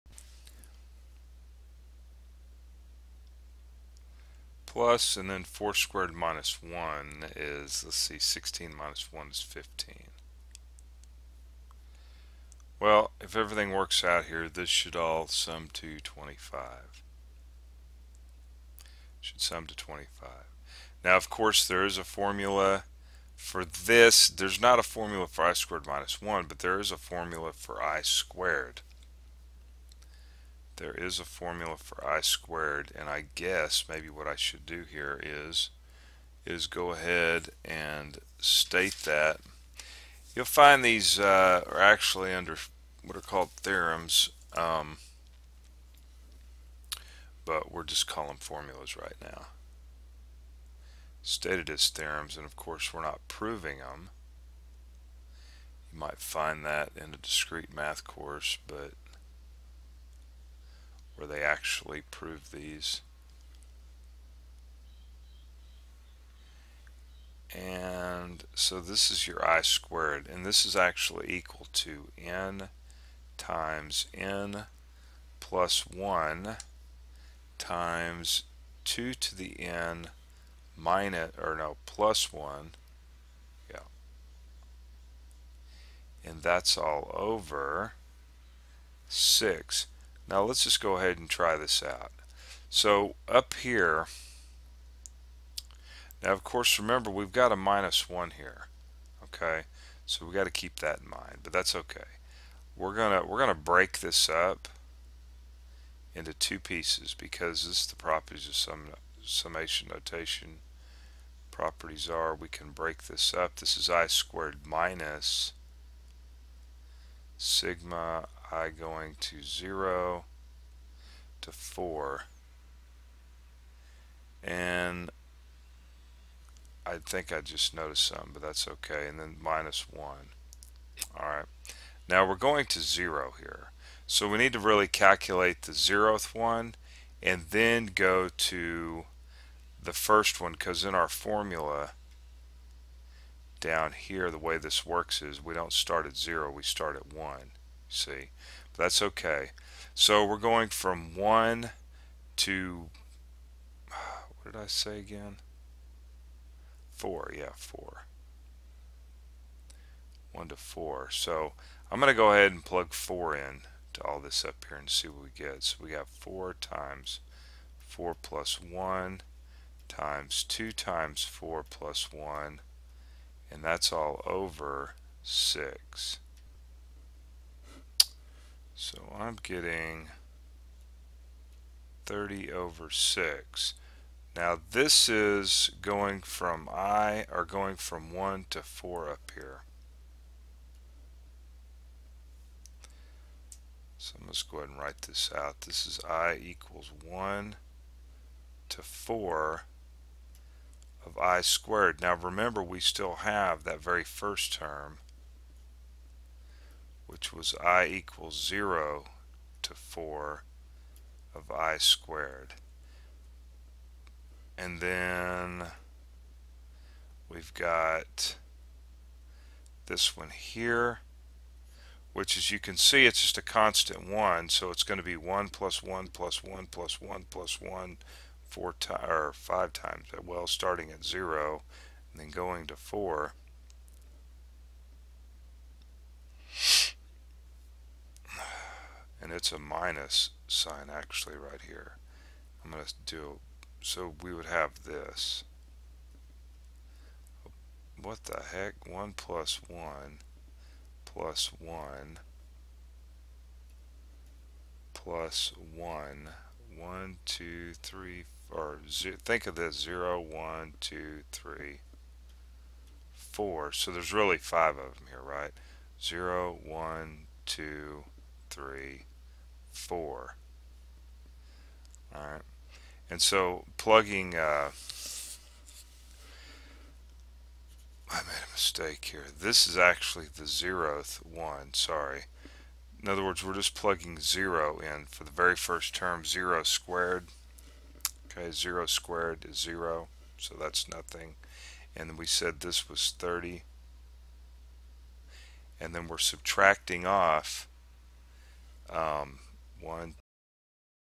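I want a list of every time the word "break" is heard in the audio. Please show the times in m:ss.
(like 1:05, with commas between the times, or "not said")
1:43, 1:52.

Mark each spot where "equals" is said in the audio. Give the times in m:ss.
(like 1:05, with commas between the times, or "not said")
1:11, 3:16, 3:27.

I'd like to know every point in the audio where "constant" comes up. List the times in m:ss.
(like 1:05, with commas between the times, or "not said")
3:43.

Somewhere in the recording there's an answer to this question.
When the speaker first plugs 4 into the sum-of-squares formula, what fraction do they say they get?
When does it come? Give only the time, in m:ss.
3:02.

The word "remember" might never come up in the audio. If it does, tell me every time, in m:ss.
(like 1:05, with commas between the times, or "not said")
1:36, 3:22.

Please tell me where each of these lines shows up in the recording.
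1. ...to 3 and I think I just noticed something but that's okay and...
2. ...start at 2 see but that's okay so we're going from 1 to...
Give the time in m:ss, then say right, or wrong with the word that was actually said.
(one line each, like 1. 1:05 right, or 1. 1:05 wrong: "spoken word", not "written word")
1. 2:01 wrong: "4", not "3"
2. 2:26 wrong: "1", not "2".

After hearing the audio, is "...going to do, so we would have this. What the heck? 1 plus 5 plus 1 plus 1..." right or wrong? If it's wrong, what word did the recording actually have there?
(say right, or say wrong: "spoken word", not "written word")
wrong: "1", not "5".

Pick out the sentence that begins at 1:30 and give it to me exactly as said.
Now let's just go ahead and try this out.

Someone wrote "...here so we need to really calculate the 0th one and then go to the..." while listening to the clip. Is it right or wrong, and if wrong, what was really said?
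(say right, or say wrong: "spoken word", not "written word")
right.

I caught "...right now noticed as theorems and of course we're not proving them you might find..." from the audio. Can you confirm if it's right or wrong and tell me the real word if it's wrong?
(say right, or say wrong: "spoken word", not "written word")
wrong: "stated", not "noticed".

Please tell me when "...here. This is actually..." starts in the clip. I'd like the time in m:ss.
4:39.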